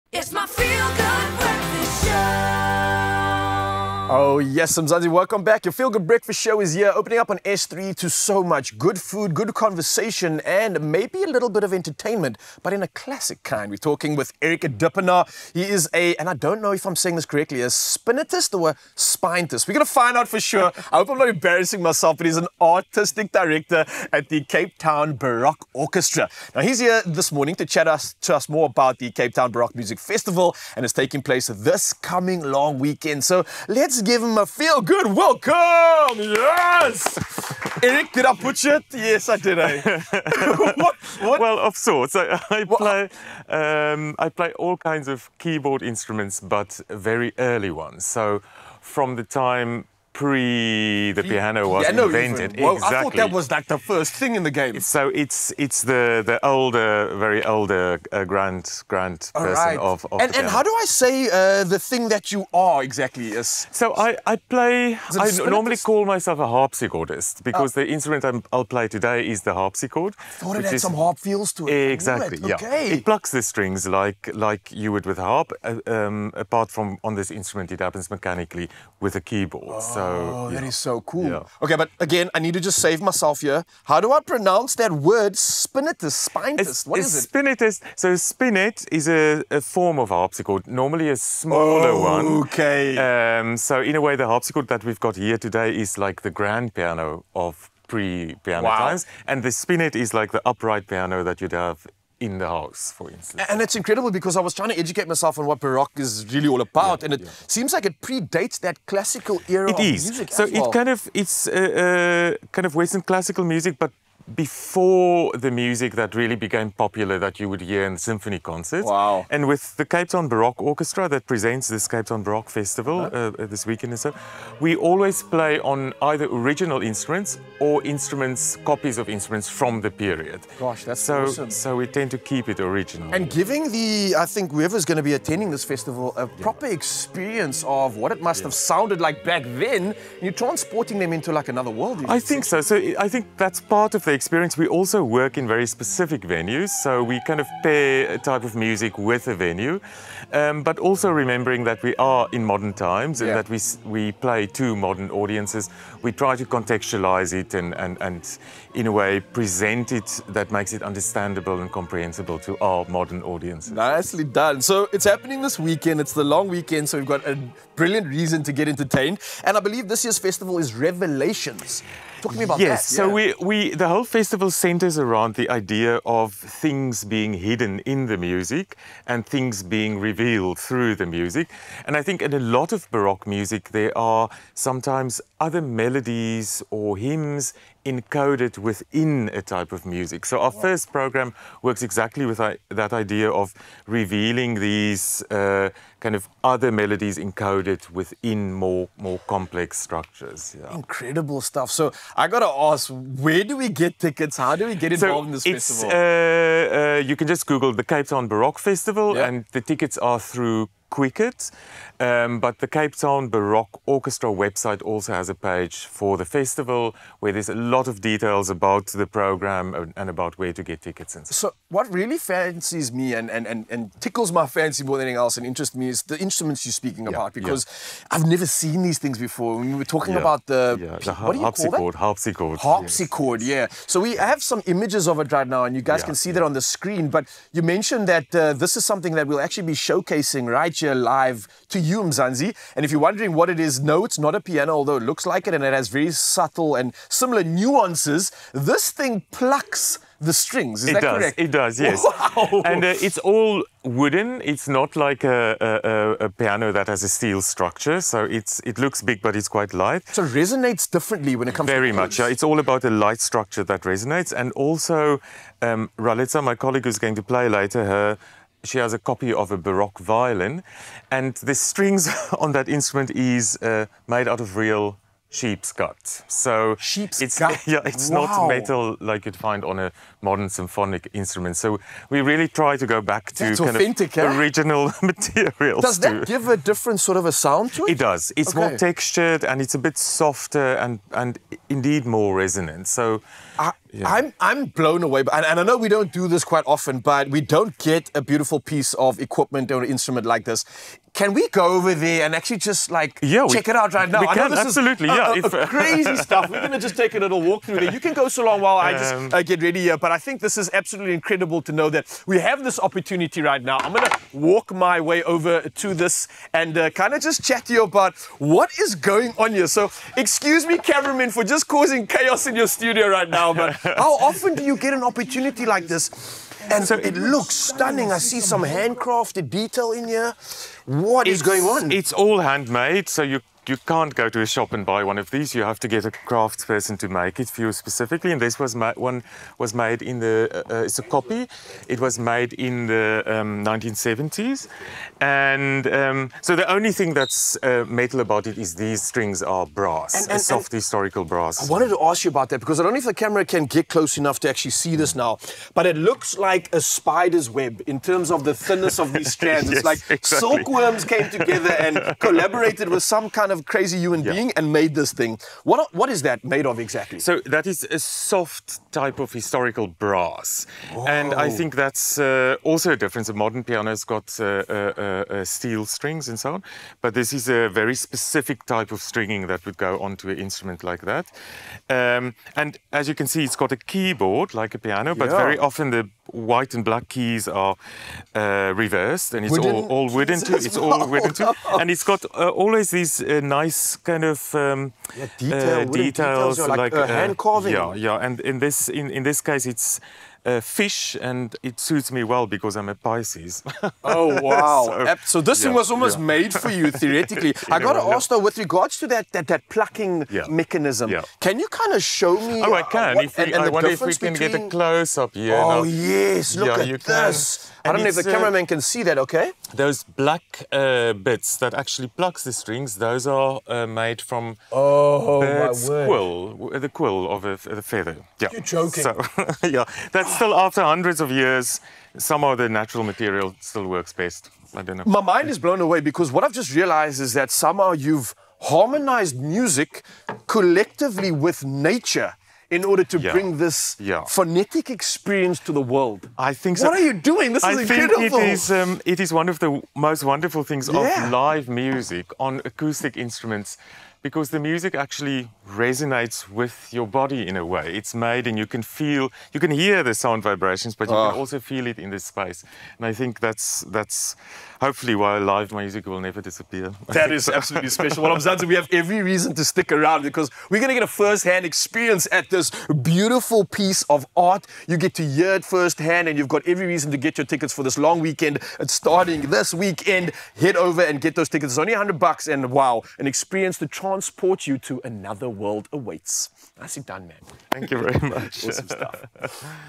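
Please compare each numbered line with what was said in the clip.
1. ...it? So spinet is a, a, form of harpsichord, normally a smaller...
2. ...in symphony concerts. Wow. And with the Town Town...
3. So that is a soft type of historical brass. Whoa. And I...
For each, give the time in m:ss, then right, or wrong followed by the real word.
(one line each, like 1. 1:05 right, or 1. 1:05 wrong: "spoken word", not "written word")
1. 1:27 right
2. 1:57 wrong: "Cape", not "Town"
3. 6:07 right.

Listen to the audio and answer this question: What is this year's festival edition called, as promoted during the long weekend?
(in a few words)
Revelations.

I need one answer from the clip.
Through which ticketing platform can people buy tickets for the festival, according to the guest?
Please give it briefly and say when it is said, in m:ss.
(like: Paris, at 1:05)
Quicket, at 3:30.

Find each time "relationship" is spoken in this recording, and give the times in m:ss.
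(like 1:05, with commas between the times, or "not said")
not said.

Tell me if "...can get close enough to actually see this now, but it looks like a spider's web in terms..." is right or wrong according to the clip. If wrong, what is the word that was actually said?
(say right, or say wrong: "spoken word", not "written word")
right.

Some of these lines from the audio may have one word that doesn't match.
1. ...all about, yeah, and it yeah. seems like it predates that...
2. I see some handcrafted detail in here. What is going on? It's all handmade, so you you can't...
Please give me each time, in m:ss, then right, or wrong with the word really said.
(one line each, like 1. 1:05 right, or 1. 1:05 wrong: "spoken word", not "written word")
1. 1:46 right
2. 5:28 right.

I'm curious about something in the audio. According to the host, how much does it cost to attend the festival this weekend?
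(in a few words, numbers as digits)
100 bucks.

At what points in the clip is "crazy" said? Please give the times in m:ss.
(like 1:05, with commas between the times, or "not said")
5:05, 6:03.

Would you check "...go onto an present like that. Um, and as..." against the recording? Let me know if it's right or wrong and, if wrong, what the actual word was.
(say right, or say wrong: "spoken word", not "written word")
wrong: "instrument", not "present".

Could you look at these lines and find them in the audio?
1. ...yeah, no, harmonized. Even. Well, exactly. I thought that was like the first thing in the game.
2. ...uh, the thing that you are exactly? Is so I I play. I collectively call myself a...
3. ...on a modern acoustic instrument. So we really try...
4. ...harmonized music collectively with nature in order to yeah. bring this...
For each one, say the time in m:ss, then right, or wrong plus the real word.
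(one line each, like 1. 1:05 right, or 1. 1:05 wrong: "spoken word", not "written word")
1. 0:51 wrong: "invented", not "harmonized"
2. 1:01 wrong: "normally", not "collectively"
3. 4:39 wrong: "symphonic", not "acoustic"
4. 7:18 right.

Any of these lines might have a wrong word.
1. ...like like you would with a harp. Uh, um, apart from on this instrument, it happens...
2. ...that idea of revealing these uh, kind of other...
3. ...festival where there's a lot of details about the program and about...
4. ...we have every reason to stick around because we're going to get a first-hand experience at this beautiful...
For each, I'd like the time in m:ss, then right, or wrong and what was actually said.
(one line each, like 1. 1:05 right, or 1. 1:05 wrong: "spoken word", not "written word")
1. 1:13 right
2. 3:12 right
3. 3:36 right
4. 7:48 right.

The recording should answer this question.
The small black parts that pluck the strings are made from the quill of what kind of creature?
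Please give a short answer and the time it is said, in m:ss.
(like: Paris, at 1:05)
Bird, at 7:05.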